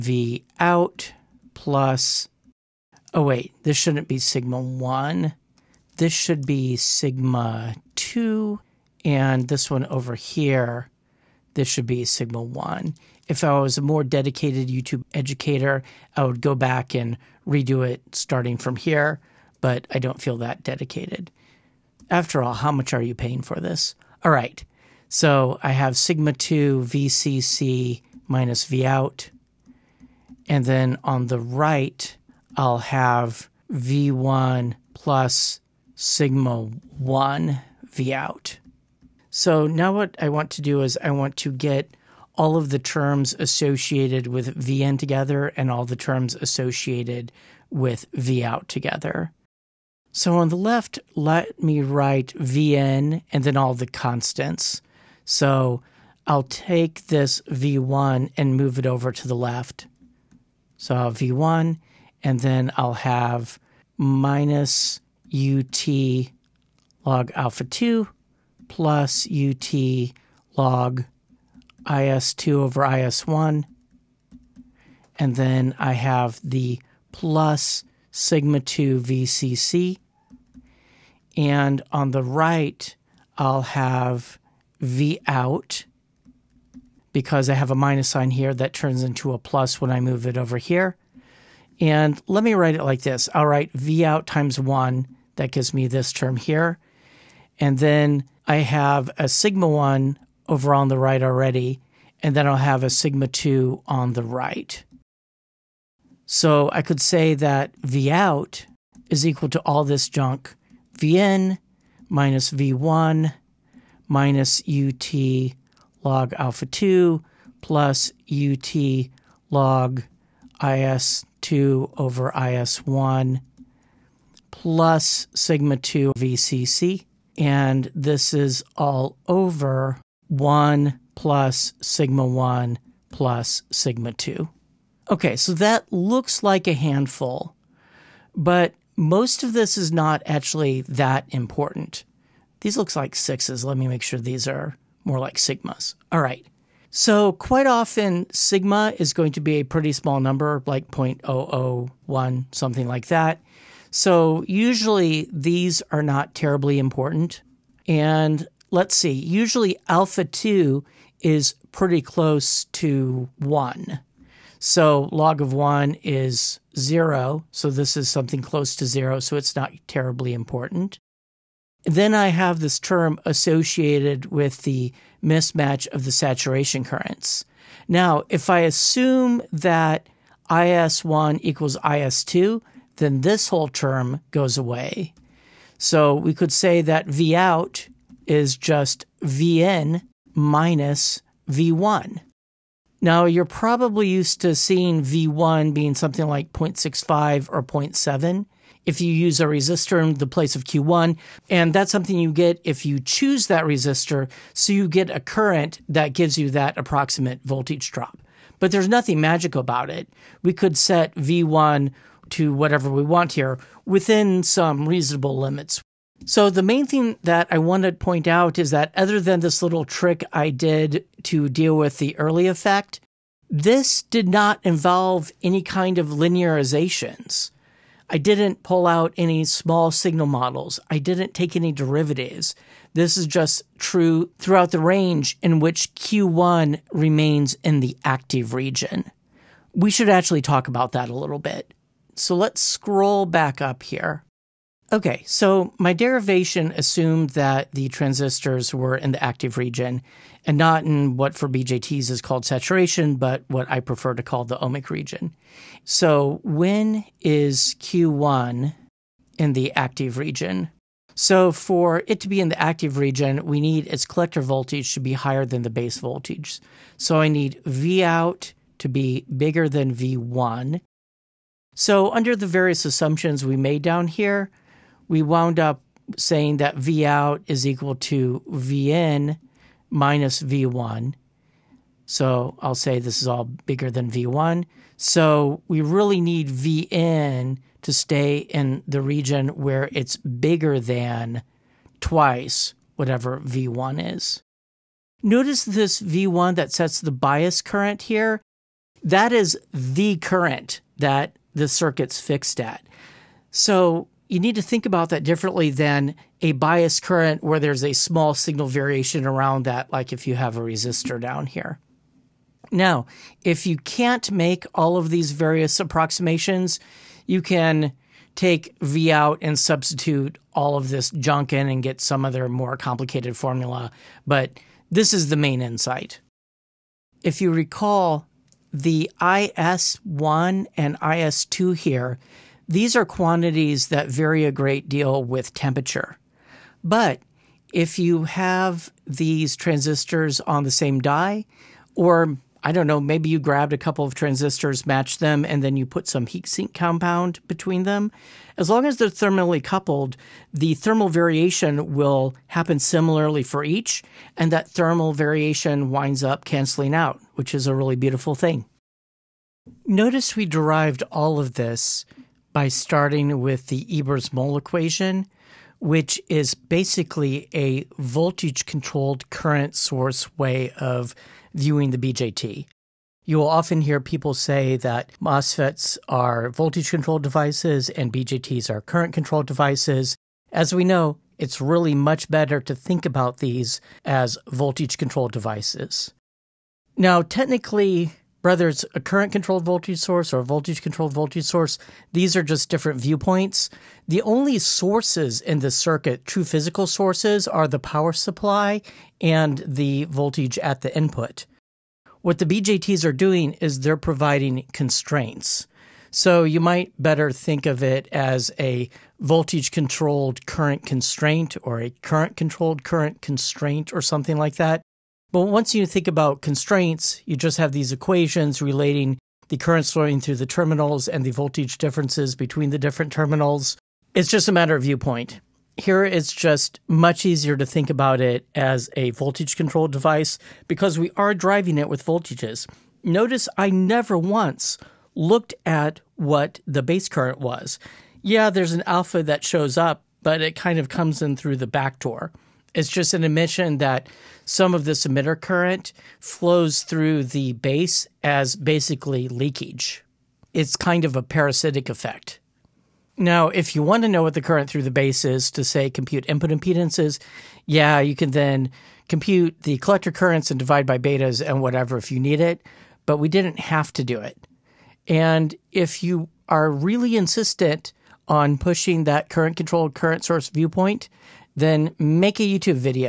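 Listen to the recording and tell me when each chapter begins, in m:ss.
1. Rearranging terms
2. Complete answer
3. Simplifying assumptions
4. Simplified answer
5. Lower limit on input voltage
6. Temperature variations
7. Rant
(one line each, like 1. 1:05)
1. 0:38
2. 1:45
3. 2:26
4. 3:05
5. 4:04
6. 5:26
7. 5:59.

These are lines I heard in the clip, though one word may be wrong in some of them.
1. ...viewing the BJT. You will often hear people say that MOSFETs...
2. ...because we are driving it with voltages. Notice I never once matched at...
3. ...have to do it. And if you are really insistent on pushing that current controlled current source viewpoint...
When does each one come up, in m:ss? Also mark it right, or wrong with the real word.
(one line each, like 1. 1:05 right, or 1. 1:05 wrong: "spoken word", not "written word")
1. 6:11 right
2. 7:10 wrong: "looked", not "matched"
3. 7:43 right.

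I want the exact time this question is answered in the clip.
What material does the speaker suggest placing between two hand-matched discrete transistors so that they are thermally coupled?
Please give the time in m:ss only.
5:46.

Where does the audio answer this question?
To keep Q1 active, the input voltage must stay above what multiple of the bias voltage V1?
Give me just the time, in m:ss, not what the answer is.
4:52.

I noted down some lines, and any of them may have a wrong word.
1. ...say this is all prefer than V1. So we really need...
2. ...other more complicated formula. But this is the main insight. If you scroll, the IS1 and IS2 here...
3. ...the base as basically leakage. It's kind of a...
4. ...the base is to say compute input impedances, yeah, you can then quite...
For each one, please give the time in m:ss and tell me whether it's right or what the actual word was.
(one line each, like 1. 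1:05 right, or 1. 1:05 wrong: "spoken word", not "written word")
1. 4:42 wrong: "bigger", not "prefer"
2. 5:22 wrong: "recall", not "scroll"
3. 7:27 right
4. 7:34 wrong: "compute", not "quite".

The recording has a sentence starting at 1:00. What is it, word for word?
So I'll v1 and then I'll have minus ut log alpha 2 plus ut log IS2 over IS1.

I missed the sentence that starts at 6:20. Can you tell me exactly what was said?
As we know, it's really much better to think about these as voltage controlled devices.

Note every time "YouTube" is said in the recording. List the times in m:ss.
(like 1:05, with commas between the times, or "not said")
0:14, 7:52.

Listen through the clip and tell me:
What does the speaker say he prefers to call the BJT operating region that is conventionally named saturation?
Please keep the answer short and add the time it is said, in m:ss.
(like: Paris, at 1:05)
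the ohmic region, at 4:14.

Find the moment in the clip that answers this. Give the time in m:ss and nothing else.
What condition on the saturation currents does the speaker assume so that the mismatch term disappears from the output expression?
3:00.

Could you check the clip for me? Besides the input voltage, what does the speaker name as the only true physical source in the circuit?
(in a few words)
the power supply.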